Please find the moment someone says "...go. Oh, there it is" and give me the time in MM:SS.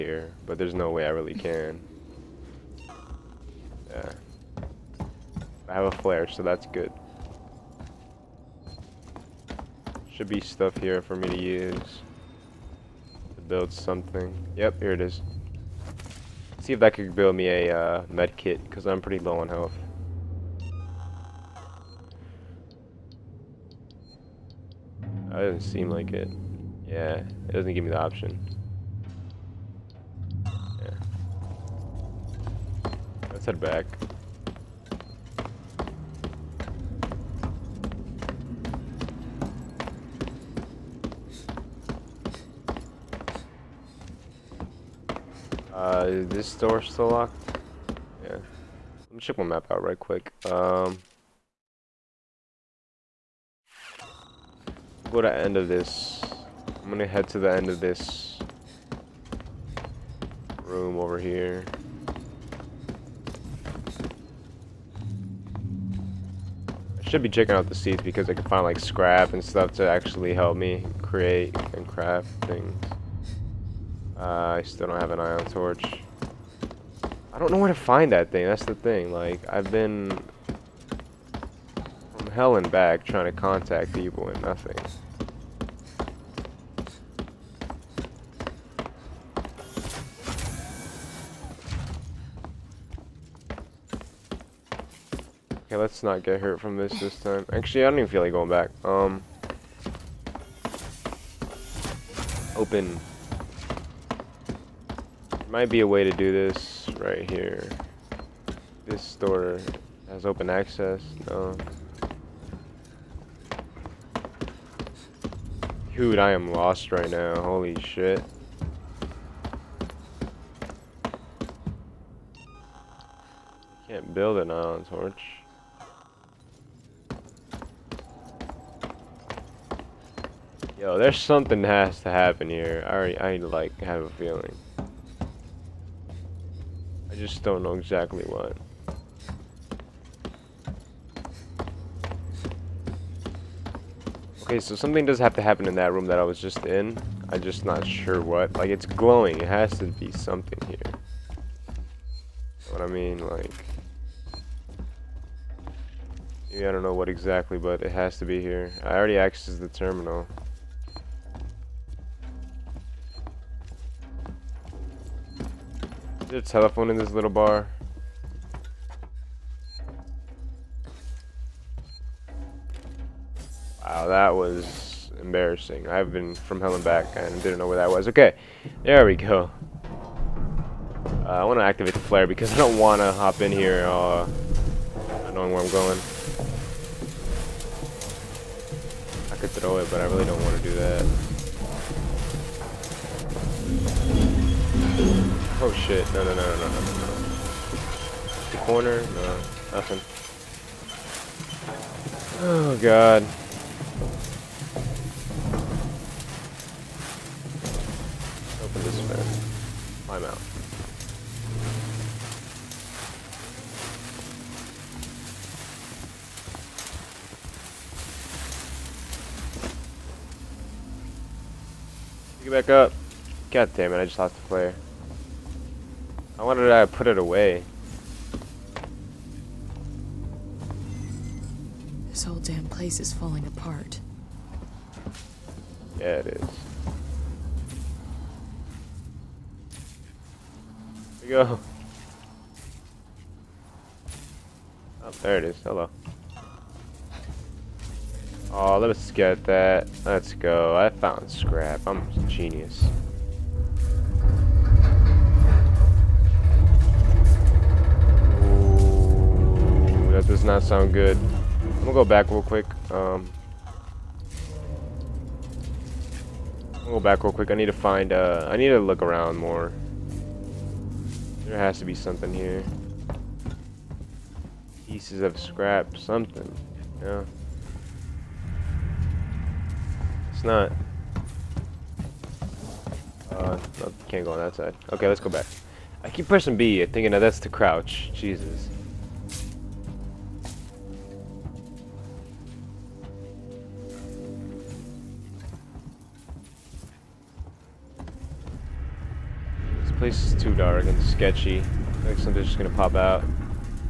04:01.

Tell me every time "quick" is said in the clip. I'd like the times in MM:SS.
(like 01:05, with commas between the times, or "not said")
00:49, 04:22, 04:27.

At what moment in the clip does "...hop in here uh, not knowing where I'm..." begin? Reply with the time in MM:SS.
03:03.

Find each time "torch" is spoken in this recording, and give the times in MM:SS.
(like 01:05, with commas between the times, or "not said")
01:15, 02:04.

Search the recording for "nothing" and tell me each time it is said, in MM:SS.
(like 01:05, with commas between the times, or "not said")
01:24, 03:19.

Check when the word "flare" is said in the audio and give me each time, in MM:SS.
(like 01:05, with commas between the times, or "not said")
00:05, 03:01.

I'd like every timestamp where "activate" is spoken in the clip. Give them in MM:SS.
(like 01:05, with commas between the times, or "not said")
03:01.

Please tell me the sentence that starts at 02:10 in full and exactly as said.
Yo, there's something has to happen here.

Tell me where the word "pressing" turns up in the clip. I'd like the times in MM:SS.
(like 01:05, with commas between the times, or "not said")
04:46.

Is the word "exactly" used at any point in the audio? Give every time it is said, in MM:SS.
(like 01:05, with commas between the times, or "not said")
02:17, 02:37.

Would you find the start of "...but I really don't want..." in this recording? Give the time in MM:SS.
03:09.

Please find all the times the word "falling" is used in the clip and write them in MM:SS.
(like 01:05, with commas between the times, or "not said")
03:53.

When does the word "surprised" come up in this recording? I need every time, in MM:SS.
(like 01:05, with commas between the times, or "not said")
not said.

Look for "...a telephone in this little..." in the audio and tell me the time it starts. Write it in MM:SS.
02:46.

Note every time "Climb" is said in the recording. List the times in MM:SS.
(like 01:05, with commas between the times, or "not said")
03:30.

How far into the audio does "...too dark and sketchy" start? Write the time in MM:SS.
05:00.